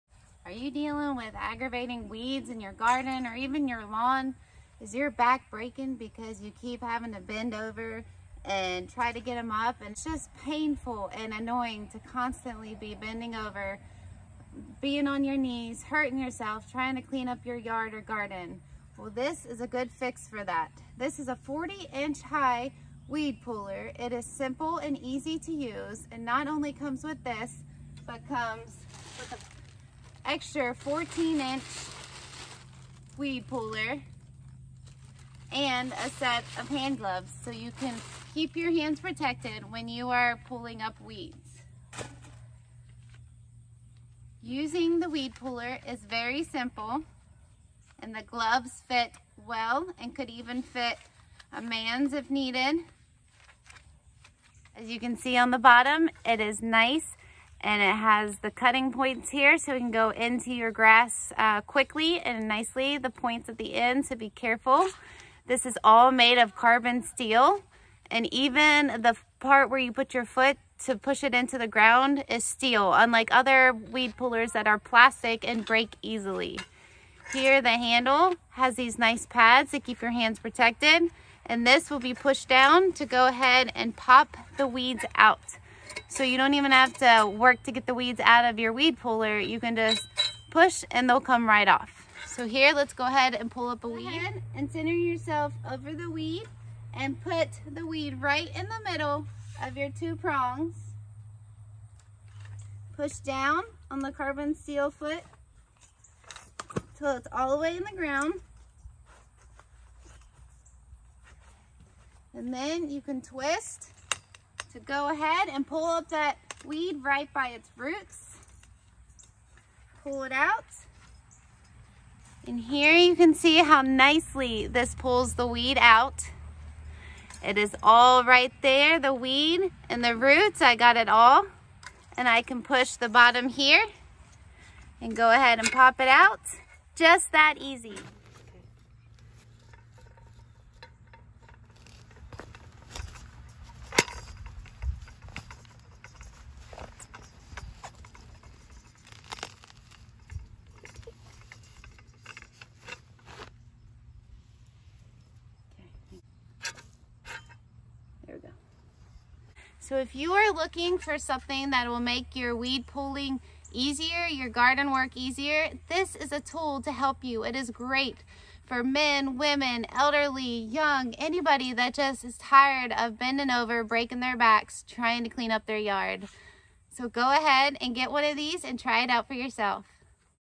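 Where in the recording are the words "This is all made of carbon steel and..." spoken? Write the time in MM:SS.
01:05.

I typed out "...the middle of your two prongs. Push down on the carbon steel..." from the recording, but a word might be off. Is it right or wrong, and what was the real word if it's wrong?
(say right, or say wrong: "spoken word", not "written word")
right.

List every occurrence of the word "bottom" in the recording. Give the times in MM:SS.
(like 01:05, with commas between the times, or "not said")
00:55, 02:13.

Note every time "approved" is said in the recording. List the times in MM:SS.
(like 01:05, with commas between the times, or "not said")
not said.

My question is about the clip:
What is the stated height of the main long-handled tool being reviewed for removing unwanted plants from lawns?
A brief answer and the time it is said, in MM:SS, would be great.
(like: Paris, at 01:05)
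40 inch, at 00:21.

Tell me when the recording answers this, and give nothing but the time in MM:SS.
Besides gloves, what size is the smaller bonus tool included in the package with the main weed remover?
00:30.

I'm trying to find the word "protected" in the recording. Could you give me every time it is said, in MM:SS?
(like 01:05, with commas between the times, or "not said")
00:38, 01:20.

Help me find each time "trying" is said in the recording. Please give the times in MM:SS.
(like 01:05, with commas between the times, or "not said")
00:16, 02:54.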